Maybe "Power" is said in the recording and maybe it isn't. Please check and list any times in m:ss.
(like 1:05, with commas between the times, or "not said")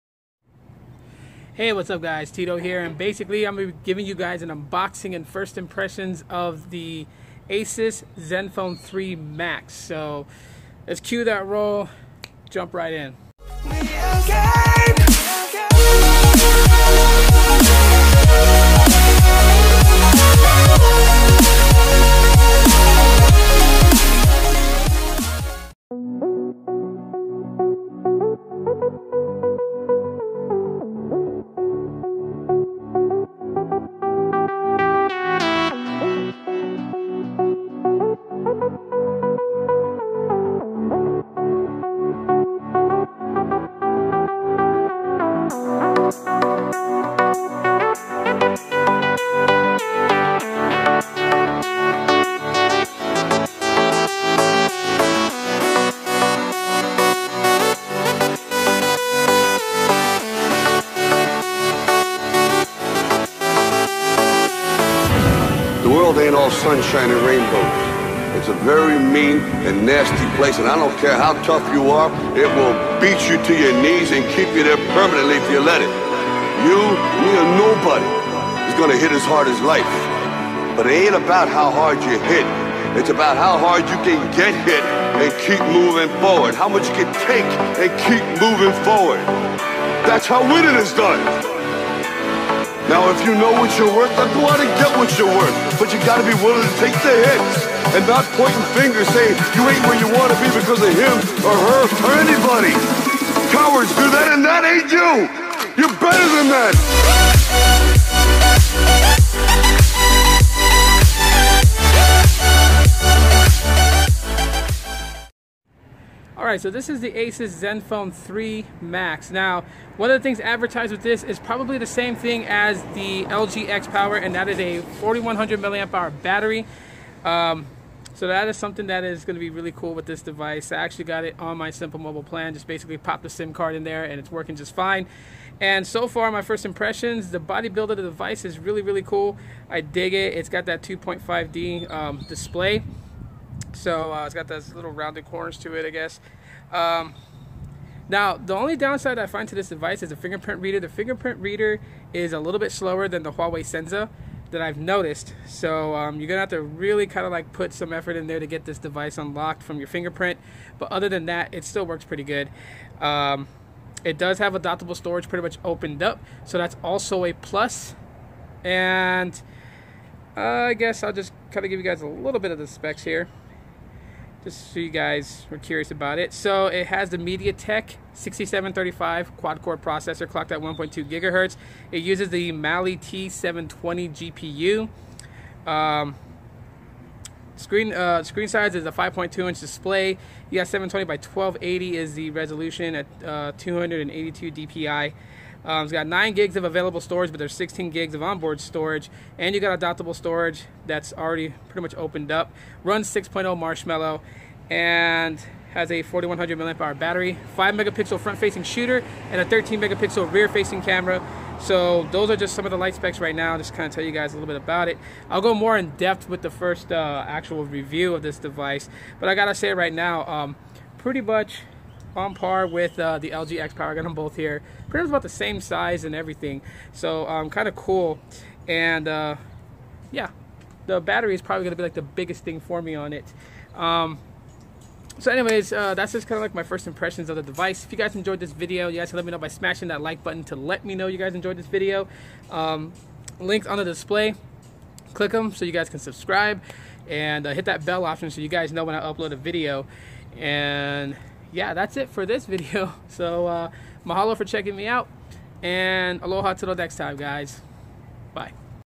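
2:03, 3:43.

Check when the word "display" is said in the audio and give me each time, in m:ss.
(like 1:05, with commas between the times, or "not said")
2:22, 3:09, 4:03.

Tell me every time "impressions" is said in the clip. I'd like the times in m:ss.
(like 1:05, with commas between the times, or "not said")
0:05, 2:16, 3:56.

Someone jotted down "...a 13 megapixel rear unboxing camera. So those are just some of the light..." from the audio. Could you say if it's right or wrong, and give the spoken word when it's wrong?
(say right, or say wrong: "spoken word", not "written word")
wrong: "facing", not "unboxing".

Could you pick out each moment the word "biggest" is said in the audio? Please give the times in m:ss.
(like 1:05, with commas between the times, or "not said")
3:52.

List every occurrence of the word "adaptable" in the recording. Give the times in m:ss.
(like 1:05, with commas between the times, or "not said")
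2:44, 3:19.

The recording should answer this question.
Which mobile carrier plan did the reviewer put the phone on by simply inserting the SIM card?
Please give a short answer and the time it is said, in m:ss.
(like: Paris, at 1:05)
Simple Mobile, at 2:11.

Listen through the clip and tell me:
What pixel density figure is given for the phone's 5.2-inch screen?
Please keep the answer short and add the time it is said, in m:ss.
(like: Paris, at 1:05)
282 DPI, at 3:13.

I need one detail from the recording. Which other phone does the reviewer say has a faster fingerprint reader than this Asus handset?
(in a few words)
Huawei Sensa.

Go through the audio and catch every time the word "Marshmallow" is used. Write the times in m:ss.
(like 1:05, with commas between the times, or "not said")
3:23.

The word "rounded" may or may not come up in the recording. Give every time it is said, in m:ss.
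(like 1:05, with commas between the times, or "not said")
2:24.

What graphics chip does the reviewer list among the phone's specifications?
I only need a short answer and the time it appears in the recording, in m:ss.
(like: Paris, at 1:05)
Mali T720, at 3:02.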